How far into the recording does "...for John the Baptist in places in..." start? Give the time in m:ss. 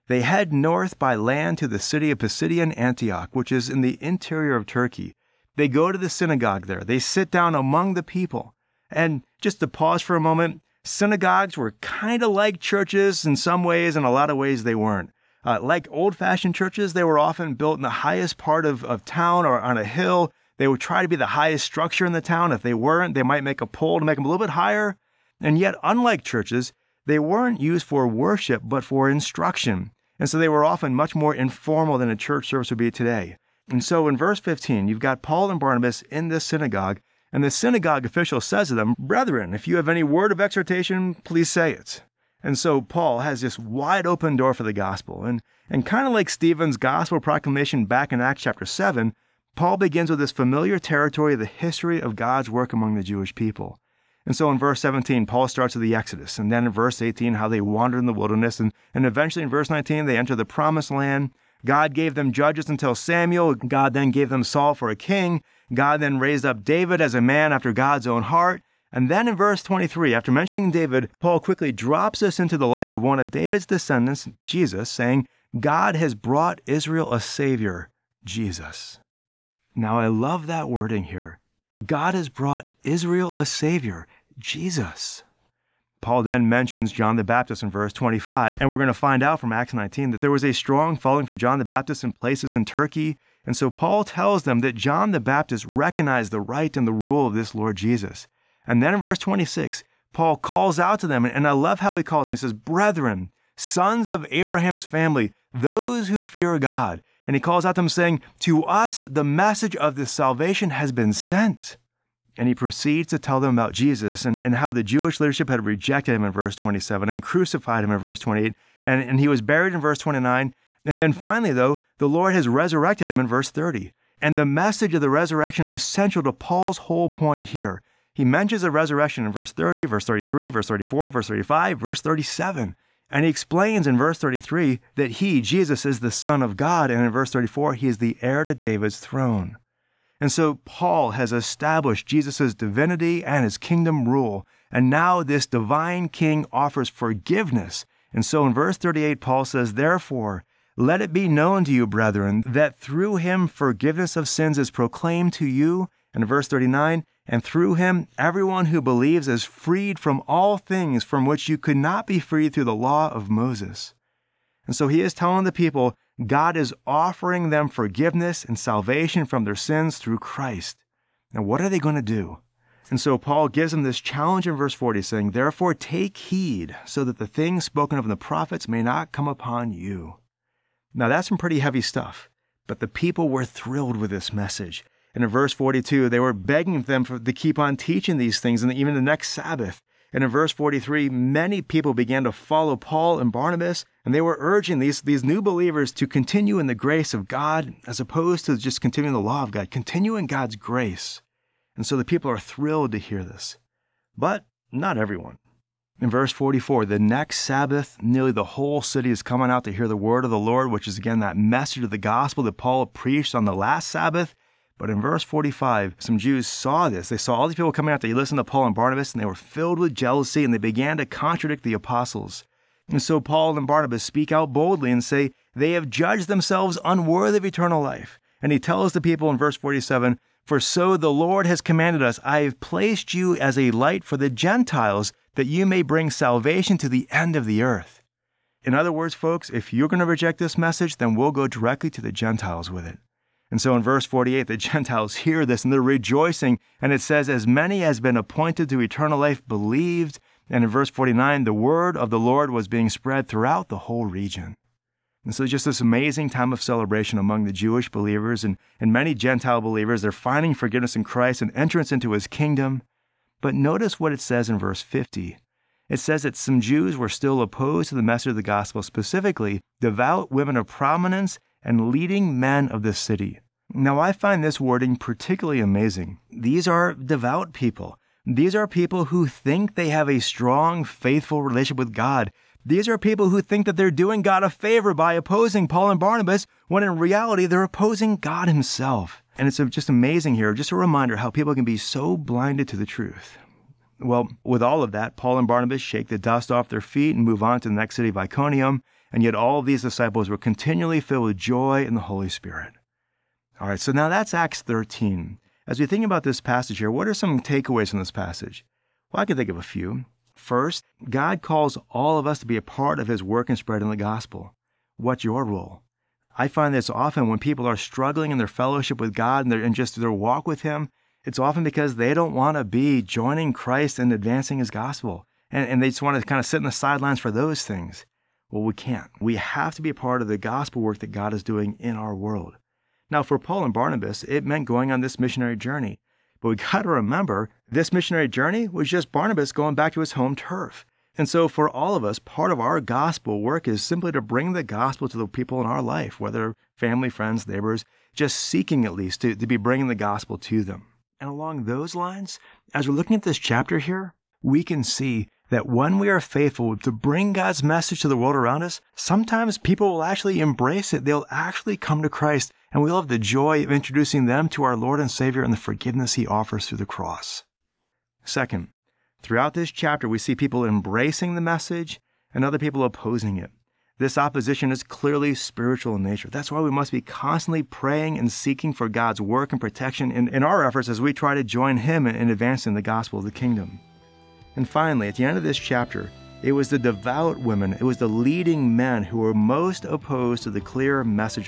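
1:31.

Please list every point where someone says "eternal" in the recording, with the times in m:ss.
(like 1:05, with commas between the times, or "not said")
3:47, 4:08.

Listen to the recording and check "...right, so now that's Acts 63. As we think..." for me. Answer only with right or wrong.
wrong.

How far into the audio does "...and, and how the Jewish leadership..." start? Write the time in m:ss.
1:54.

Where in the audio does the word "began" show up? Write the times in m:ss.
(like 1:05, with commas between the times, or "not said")
3:11, 3:40.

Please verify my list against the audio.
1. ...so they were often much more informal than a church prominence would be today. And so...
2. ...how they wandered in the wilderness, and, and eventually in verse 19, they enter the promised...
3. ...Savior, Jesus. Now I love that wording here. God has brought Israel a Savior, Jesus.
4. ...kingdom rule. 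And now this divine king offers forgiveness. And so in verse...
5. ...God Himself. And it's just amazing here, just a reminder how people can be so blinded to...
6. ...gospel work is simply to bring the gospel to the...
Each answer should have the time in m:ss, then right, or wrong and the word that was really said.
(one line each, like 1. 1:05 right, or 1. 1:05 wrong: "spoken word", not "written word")
1. 0:30 wrong: "service", not "prominence"
2. 0:57 right
3. 1:17 right
4. 2:23 right
5. 4:48 right
6. 5:42 right.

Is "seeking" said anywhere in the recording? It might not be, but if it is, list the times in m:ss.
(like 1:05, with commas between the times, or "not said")
5:48, 6:18.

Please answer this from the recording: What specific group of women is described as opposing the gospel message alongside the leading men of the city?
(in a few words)
Devout women of prominence.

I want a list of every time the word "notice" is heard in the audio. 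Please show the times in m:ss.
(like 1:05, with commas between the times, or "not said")
4:23.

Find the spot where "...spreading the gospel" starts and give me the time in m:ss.
5:13.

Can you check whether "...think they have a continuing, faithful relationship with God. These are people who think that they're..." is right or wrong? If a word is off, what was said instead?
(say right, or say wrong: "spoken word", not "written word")
wrong: "strong", not "continuing".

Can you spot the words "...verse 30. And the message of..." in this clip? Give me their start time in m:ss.
2:03.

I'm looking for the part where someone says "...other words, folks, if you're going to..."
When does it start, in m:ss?
3:58.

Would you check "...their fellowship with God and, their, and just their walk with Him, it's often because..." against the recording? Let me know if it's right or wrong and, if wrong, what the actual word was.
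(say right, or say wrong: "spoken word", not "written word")
right.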